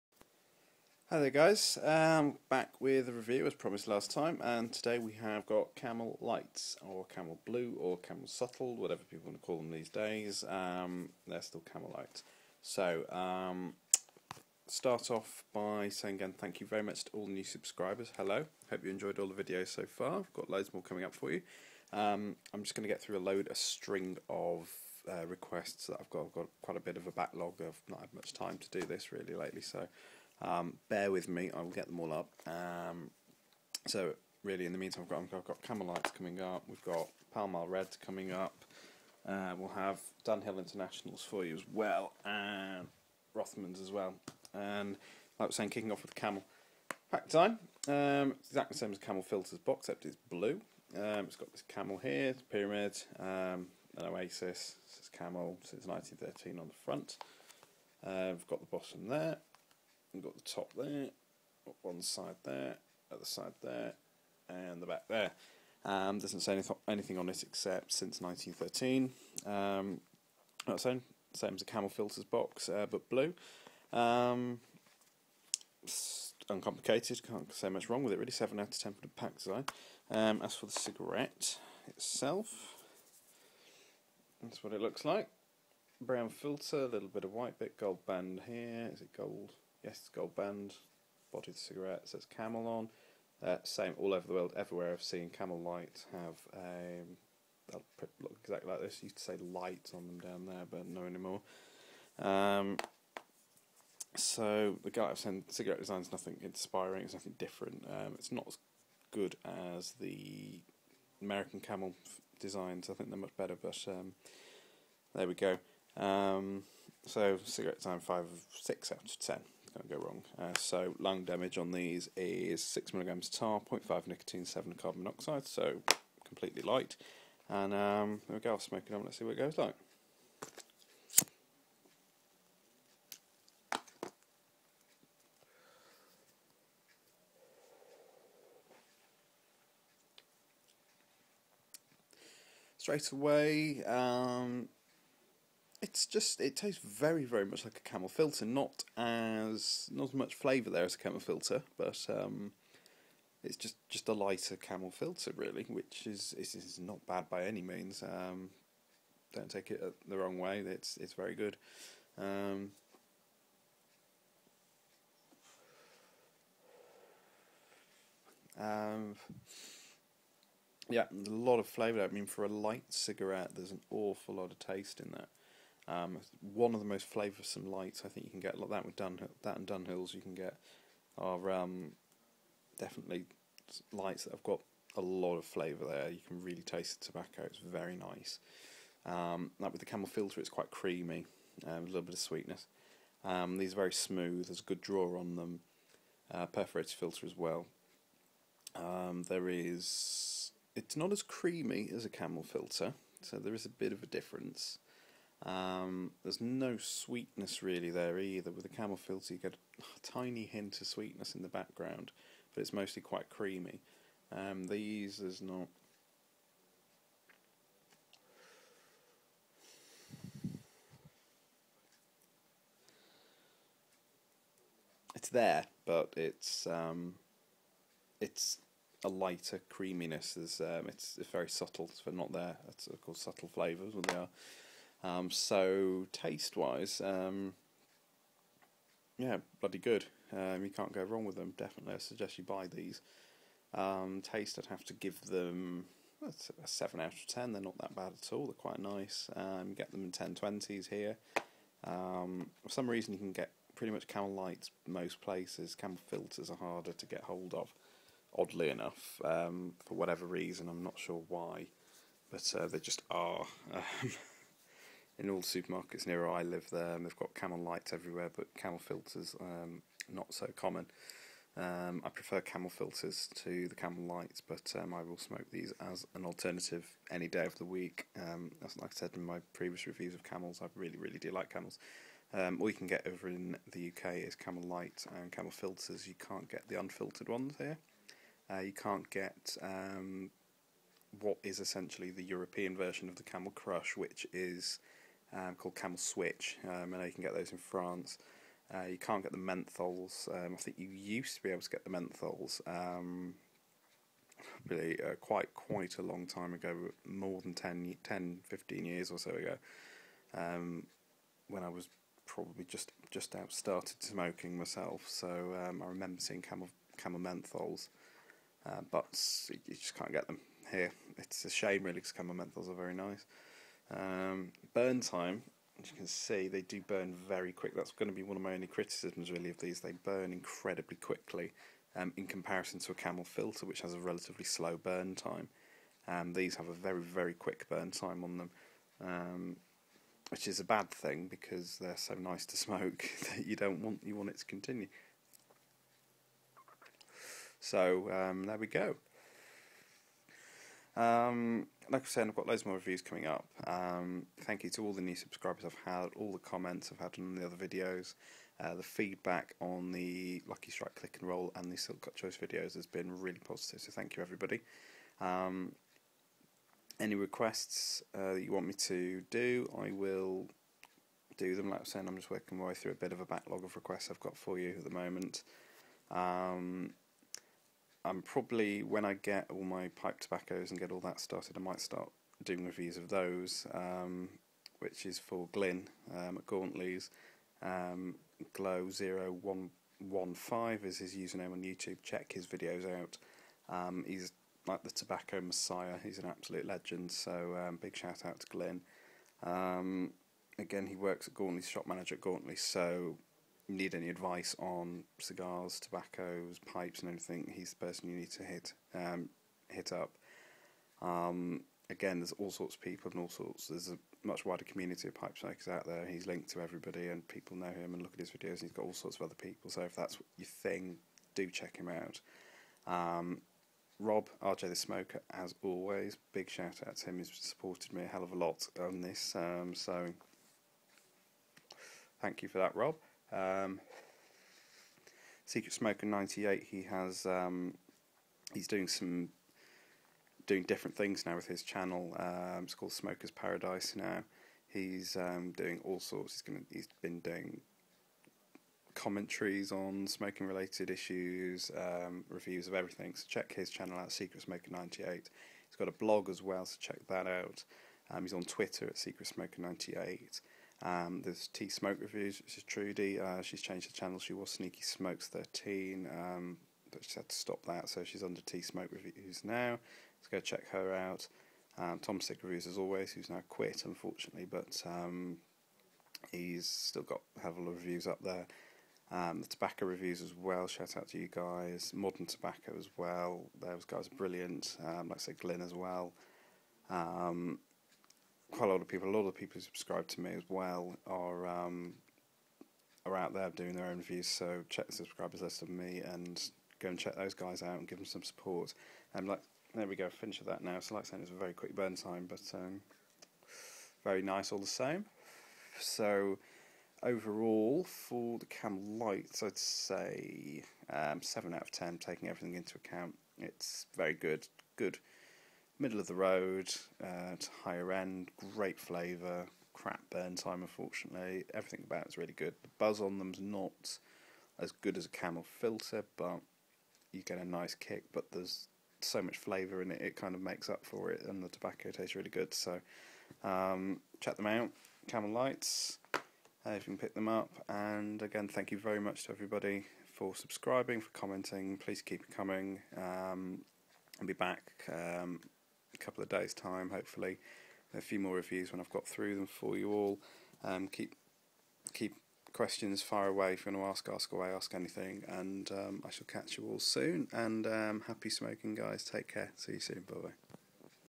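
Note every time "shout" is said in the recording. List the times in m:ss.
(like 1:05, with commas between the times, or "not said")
6:37, 7:06, 8:00.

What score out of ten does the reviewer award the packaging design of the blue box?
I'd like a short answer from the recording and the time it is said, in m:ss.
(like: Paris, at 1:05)
7, at 1:18.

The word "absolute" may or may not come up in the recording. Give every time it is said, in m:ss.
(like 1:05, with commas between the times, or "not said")
6:36.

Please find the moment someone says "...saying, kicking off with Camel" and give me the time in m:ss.
0:45.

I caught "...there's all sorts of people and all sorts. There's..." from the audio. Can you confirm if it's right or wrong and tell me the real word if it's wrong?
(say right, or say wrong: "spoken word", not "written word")
right.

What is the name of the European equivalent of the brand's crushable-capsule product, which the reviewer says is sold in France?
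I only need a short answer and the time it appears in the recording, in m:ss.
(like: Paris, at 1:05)
Camel Switch, at 4:55.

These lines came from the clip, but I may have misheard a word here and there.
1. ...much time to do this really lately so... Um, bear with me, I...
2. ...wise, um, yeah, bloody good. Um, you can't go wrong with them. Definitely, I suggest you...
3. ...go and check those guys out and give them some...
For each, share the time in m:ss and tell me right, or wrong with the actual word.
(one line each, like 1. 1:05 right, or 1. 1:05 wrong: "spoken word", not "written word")
1. 0:28 right
2. 3:56 right
3. 8:16 right.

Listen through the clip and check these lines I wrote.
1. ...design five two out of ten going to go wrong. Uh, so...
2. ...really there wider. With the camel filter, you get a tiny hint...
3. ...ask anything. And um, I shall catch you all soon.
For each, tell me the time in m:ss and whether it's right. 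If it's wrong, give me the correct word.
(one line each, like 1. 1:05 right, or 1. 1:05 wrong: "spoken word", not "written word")
1. 1:57 wrong: "six", not "two"
2. 3:27 wrong: "either", not "wider"
3. 9:14 right.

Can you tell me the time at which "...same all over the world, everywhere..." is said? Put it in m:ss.
1:33.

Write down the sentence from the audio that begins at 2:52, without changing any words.
I mean, for a light cigarette, there's an awful lot of taste in that.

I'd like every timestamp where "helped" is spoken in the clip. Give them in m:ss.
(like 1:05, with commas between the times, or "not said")
not said.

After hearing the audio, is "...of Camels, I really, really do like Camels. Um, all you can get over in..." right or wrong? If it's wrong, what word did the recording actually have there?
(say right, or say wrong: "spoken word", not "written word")
right.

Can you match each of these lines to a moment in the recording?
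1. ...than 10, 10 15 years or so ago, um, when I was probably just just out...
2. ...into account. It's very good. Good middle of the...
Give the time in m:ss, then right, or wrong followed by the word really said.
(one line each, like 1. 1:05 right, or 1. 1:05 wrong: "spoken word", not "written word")
1. 5:07 right
2. 8:32 right.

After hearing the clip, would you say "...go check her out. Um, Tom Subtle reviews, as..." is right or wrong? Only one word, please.
wrong.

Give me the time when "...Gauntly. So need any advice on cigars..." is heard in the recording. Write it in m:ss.
6:42.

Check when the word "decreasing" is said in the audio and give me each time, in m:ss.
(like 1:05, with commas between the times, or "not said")
not said.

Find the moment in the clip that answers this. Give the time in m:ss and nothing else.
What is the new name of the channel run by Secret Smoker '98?
7:22.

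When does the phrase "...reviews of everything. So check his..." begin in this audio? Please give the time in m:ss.
7:32.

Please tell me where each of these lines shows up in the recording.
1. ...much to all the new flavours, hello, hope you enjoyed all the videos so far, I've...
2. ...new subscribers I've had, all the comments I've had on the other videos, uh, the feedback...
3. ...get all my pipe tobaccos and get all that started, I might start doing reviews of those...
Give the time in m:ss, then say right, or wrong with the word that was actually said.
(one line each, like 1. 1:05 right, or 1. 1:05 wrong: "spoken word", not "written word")
1. 0:16 wrong: "subscribers", not "flavours"
2. 5:55 right
3. 6:19 right.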